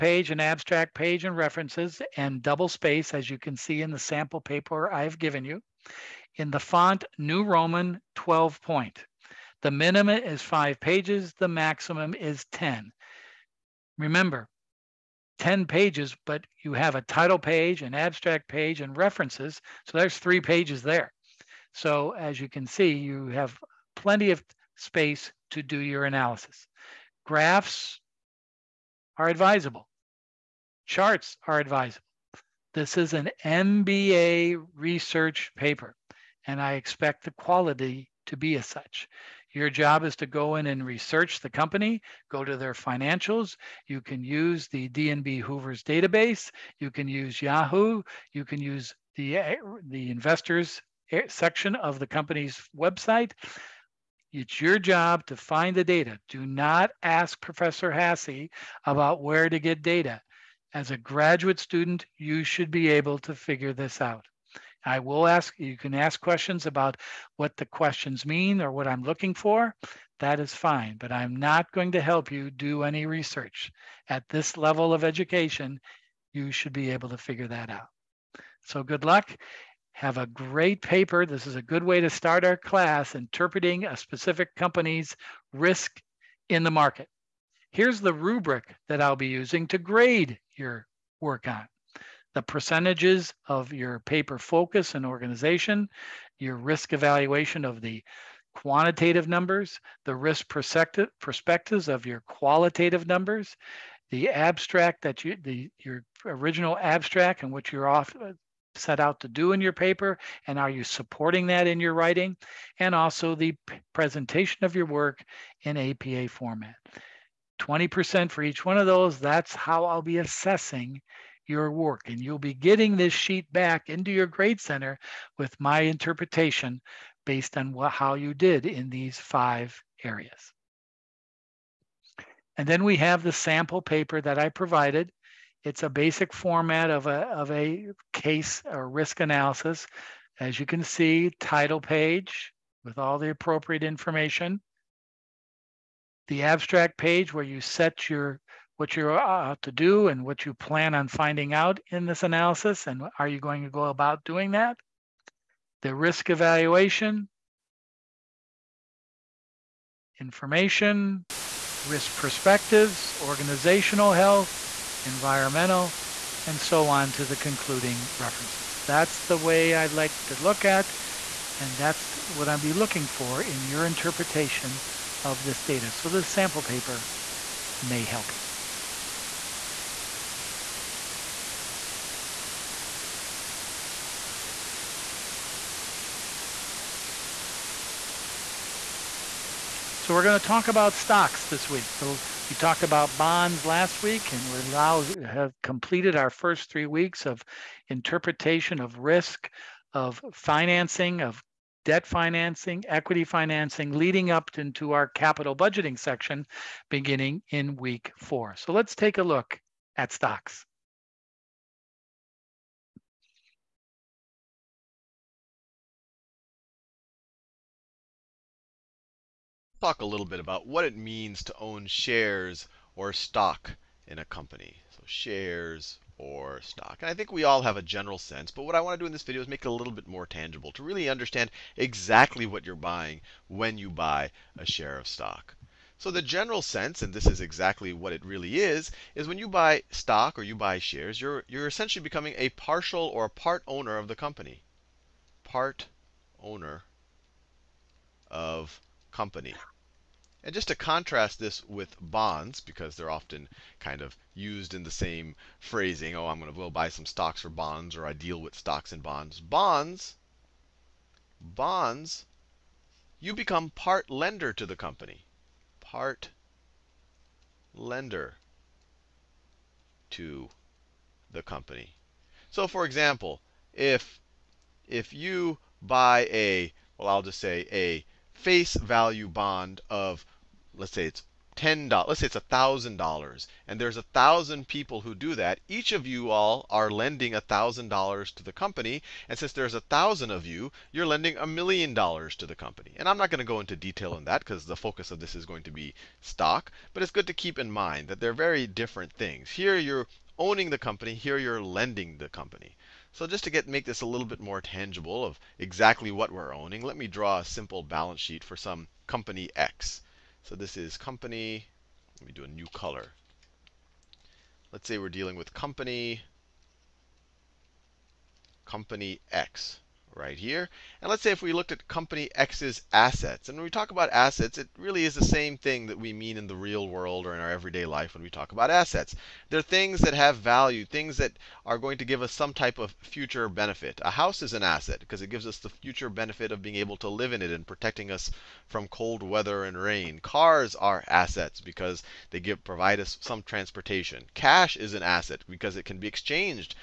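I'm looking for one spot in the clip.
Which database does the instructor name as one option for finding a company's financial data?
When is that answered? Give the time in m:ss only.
0:44.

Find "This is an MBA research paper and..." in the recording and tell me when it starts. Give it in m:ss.
0:32.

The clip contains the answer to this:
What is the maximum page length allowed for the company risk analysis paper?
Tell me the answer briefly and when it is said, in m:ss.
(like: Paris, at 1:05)
10, at 0:11.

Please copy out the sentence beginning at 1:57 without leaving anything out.
20% for each one of those, that's how I'll be assessing your work.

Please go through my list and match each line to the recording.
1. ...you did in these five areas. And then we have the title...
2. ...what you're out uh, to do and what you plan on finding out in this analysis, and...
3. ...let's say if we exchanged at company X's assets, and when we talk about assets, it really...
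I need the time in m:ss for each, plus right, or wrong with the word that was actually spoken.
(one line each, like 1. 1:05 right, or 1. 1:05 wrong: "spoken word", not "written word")
1. 2:08 wrong: "sample", not "title"
2. 2:28 right
3. 5:21 wrong: "looked", not "exchanged".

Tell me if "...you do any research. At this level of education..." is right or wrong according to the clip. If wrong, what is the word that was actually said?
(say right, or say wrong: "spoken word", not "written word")
right.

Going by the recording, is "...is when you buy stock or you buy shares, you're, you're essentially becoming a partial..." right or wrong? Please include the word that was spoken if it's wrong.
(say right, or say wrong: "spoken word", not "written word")
right.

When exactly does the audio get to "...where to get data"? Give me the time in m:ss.
0:59.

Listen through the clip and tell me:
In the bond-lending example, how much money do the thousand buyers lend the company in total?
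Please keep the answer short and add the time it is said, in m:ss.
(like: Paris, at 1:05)
a million dollars, at 4:51.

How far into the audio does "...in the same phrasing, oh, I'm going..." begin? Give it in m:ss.
4:14.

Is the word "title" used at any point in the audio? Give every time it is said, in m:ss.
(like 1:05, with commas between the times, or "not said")
0:17, 2:21.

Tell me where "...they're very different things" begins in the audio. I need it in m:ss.
4:58.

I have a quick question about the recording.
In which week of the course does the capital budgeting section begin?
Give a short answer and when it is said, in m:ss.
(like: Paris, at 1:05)
week four, at 3:27.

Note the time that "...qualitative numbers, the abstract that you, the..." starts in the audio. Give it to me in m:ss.
1:42.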